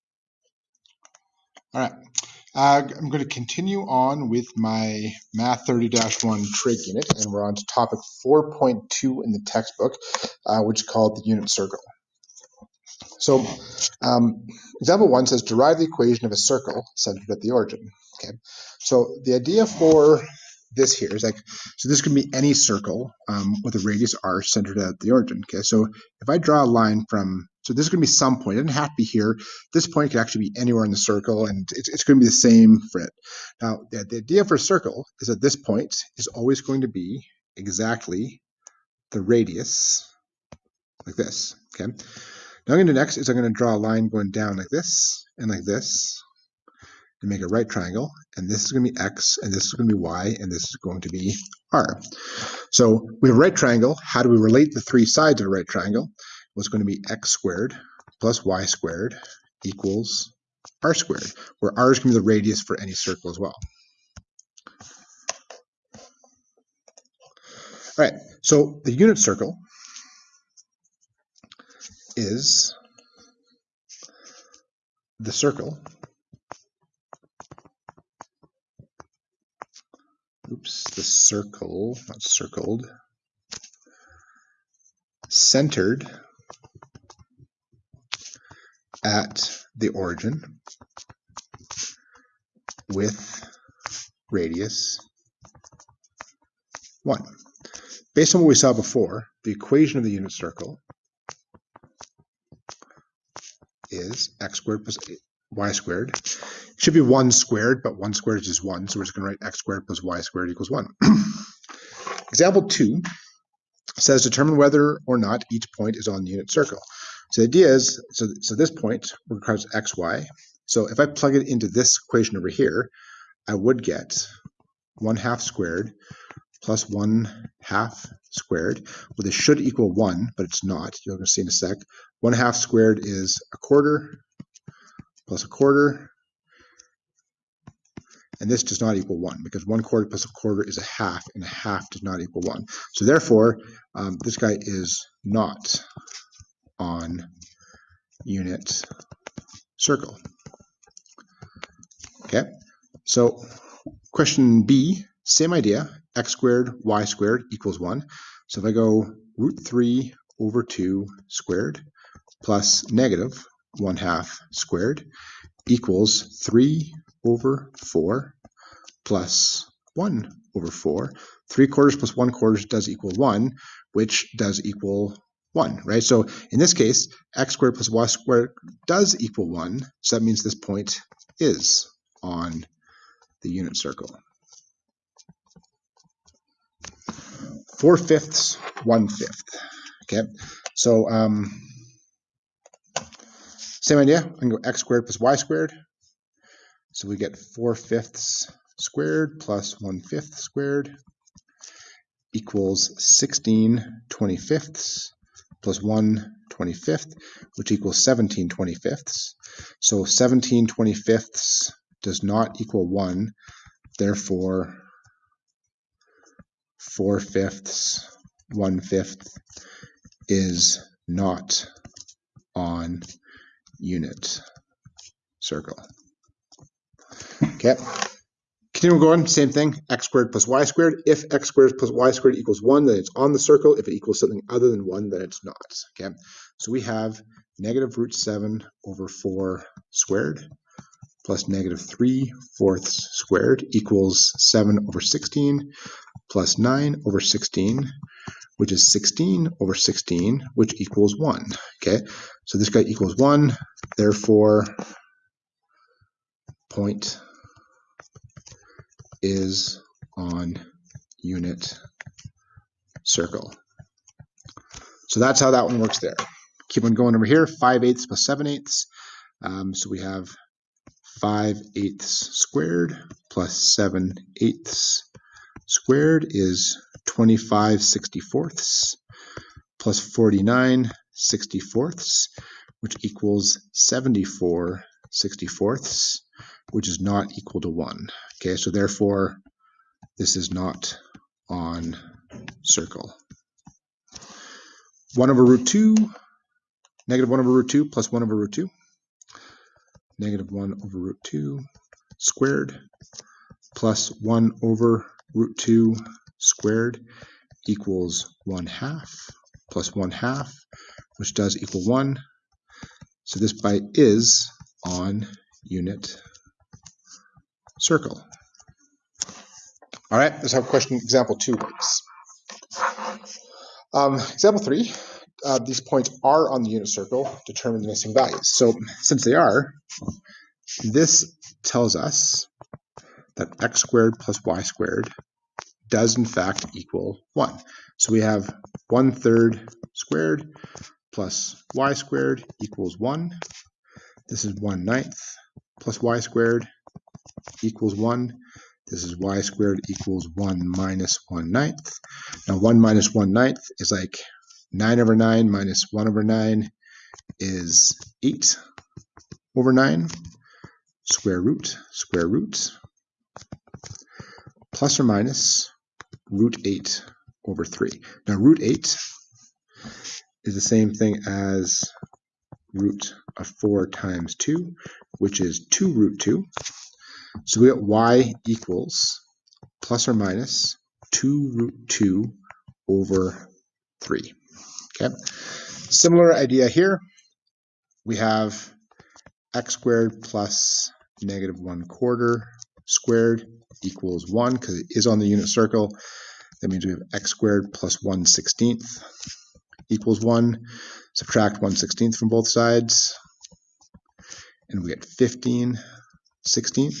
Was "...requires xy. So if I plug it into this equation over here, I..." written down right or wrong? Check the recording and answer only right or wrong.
right.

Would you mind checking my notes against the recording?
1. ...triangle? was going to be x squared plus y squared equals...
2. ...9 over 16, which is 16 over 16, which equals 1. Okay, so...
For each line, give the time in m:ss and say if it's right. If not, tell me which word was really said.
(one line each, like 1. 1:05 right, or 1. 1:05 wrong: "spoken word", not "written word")
1. 0:55 right
2. 4:06 right.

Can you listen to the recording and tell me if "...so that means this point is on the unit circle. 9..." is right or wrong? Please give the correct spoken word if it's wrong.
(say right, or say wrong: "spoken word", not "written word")
wrong: "4", not "9".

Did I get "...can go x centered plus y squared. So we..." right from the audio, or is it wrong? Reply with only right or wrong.
wrong.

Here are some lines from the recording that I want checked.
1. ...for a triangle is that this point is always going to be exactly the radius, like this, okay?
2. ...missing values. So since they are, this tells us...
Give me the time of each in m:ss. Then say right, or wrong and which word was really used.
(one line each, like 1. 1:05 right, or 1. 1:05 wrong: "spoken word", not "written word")
1. 0:34 wrong: "circle", not "triangle"
2. 5:27 right.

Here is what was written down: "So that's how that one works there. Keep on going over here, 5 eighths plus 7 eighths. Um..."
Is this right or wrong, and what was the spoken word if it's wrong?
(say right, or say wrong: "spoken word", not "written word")
right.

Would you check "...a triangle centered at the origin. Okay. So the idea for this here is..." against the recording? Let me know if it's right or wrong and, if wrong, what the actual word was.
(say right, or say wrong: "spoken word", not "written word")
wrong: "circle", not "triangle".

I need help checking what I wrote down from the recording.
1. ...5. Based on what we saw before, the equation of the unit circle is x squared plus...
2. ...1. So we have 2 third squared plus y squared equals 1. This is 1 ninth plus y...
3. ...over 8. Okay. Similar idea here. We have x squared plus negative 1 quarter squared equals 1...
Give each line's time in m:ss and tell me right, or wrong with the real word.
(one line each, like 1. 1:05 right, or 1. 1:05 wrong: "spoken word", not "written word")
1. 1:37 wrong: "1", not "5"
2. 5:37 wrong: "1", not "2"
3. 6:22 wrong: "3", not "8".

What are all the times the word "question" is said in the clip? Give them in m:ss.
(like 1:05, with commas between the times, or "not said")
2:34, 5:20.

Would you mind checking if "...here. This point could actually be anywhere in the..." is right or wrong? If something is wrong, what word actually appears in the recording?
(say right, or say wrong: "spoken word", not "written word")
right.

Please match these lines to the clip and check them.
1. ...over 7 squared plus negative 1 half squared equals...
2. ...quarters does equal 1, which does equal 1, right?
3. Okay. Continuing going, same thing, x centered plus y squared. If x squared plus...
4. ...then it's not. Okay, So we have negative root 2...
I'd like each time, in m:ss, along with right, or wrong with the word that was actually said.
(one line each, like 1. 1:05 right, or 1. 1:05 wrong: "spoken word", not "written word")
1. 2:40 wrong: "2", not "7"
2. 2:52 right
3. 3:47 wrong: "squared", not "centered"
4. 3:55 wrong: "7", not "2".